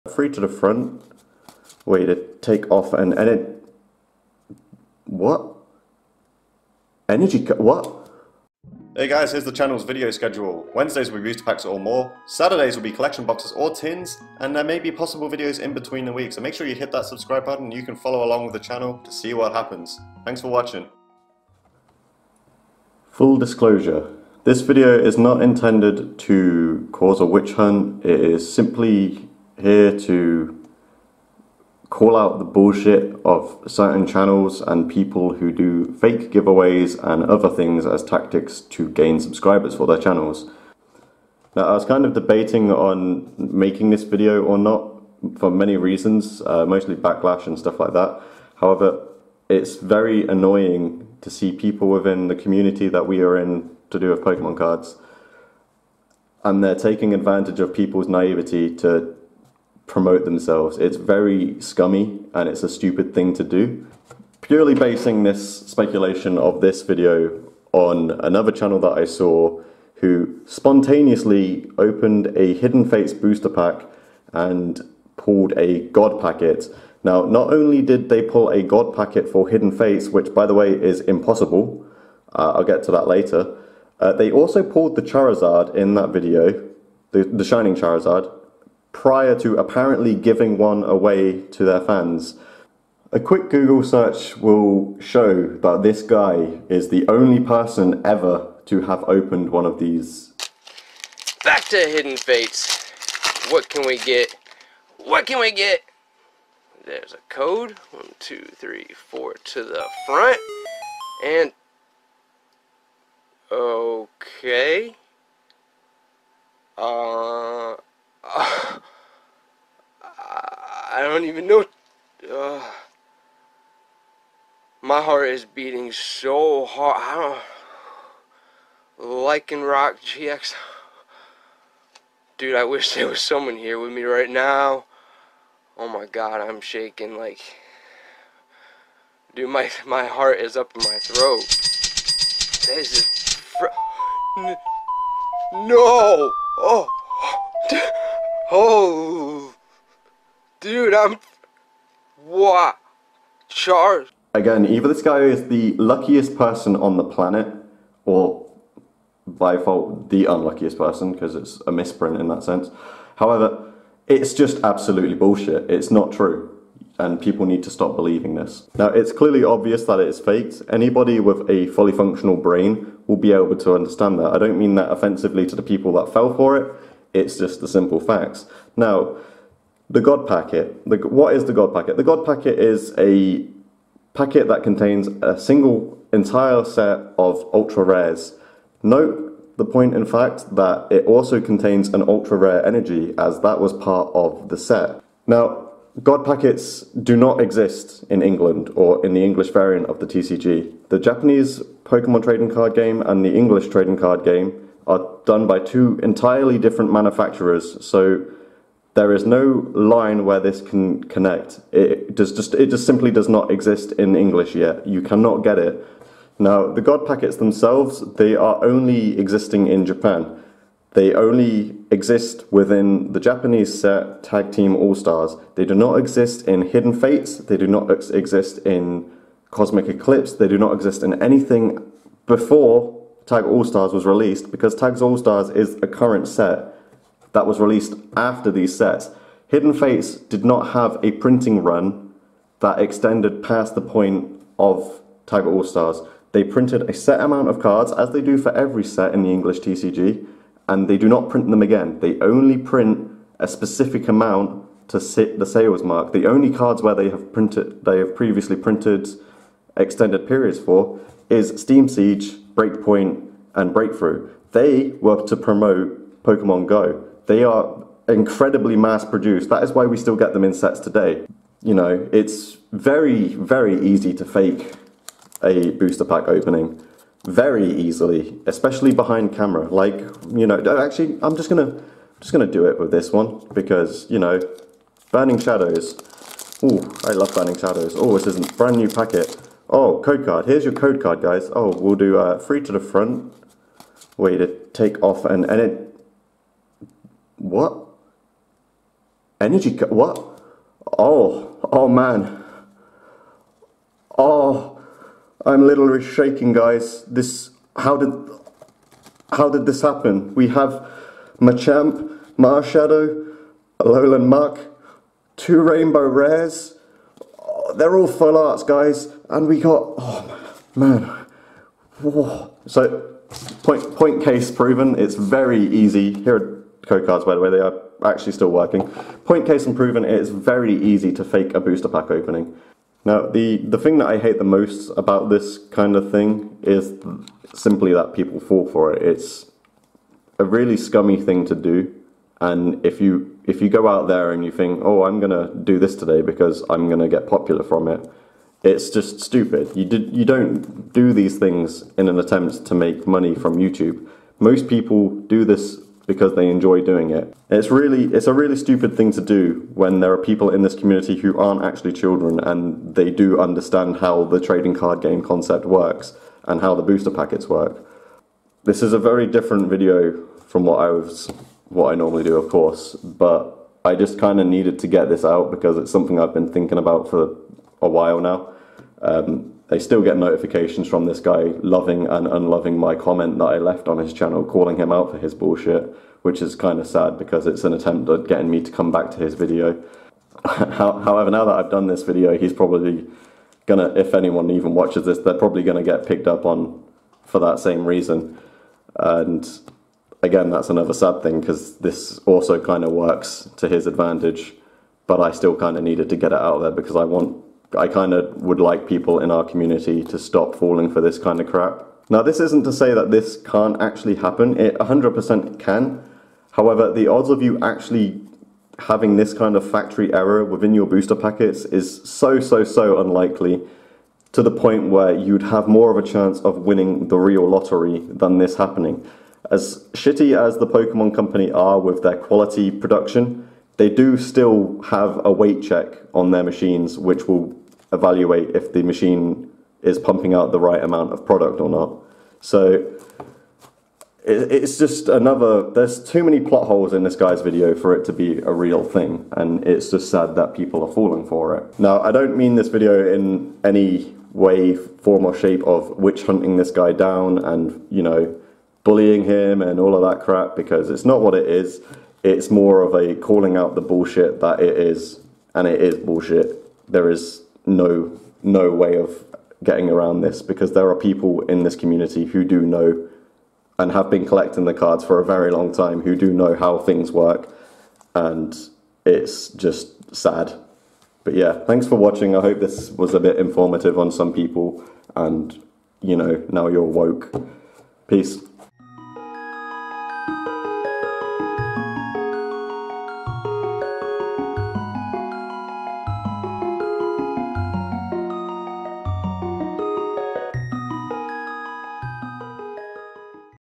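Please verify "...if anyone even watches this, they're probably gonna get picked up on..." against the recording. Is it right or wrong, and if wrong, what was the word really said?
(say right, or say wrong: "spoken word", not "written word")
right.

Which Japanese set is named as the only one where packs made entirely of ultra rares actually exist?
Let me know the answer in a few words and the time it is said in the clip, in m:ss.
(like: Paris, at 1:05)
Tag Team All Stars, at 3:44.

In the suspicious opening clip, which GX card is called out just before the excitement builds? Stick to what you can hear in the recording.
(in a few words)
Lycanroc GX.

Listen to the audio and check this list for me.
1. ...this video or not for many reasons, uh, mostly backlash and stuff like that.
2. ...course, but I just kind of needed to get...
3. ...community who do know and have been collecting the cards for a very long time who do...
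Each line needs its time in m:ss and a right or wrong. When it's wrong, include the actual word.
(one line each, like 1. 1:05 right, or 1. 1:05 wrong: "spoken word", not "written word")
1. 0:43 right
2. 6:12 right
3. 7:51 right.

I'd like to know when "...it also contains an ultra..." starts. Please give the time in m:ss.
3:10.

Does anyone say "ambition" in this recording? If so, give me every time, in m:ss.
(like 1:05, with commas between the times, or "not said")
not said.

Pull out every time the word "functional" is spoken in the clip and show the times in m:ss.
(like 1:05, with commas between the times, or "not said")
2:51.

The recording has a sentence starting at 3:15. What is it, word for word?
Now, God packets do not exist in England or in the English variant of the TCG.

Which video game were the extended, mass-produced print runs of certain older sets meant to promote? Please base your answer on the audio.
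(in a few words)
Pokemon Go.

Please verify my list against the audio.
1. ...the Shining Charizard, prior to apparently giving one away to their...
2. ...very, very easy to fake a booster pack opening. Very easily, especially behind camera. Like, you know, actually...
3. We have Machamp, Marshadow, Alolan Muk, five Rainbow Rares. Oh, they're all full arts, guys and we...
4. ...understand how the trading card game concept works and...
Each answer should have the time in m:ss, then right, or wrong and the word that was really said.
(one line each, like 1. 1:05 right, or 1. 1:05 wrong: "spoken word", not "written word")
1. 1:27 right
2. 4:32 right
3. 5:10 wrong: "two", not "five"
4. 6:03 right.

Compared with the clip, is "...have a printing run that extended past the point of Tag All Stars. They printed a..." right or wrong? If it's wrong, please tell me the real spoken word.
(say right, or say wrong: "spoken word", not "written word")
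right.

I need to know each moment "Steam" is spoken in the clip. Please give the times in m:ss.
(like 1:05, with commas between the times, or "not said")
4:21.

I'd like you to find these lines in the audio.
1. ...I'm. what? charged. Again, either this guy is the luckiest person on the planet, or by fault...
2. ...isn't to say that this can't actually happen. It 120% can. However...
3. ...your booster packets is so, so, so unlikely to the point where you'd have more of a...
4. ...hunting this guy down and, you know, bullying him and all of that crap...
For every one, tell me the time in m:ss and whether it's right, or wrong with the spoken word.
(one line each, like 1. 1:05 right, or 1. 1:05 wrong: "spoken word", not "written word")
1. 2:30 right
2. 6:52 wrong: "100", not "120"
3. 7:00 right
4. 7:36 right.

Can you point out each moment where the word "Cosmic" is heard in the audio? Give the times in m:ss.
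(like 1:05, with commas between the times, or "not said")
3:49.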